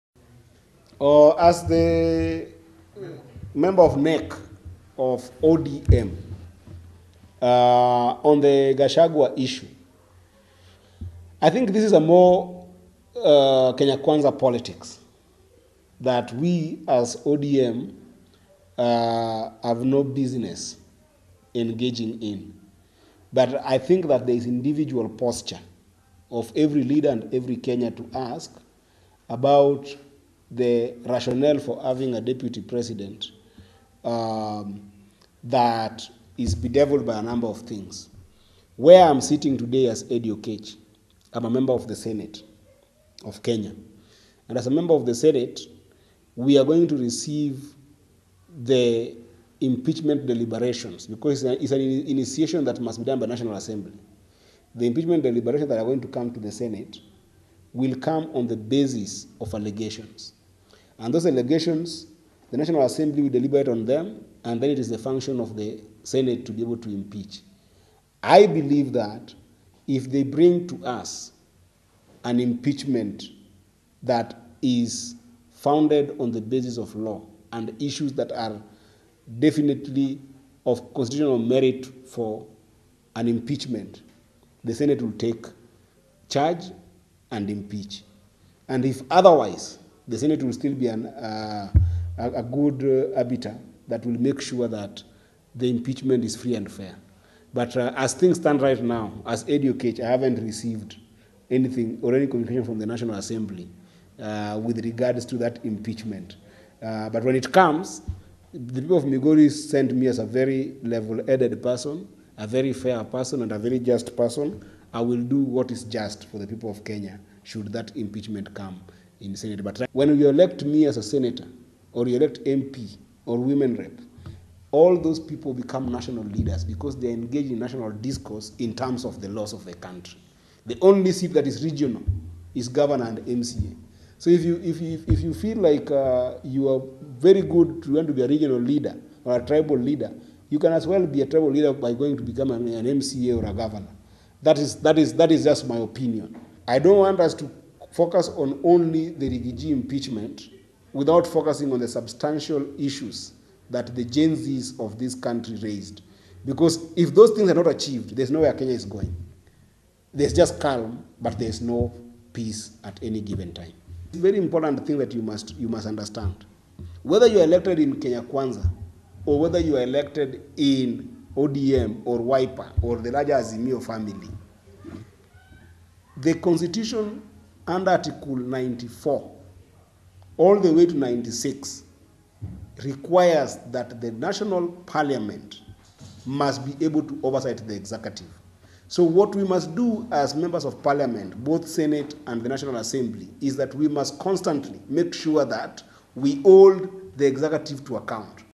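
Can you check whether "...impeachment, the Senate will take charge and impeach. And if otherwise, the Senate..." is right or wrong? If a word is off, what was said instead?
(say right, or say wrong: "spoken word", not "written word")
right.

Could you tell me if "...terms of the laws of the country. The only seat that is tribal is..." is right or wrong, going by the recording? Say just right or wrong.
wrong.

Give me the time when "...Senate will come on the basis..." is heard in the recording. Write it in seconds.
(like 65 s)
56 s.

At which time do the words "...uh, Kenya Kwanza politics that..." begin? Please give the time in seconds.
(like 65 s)
13 s.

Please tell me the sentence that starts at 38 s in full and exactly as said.
Where I'm sitting today as Eddy Oketch, I'm a member of the Senate of Kenya.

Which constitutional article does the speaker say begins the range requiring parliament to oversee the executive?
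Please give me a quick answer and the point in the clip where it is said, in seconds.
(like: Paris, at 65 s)
94, at 178 s.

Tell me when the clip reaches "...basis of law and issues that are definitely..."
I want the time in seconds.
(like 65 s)
76 s.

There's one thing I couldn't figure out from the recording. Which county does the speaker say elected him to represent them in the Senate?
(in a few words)
Migori.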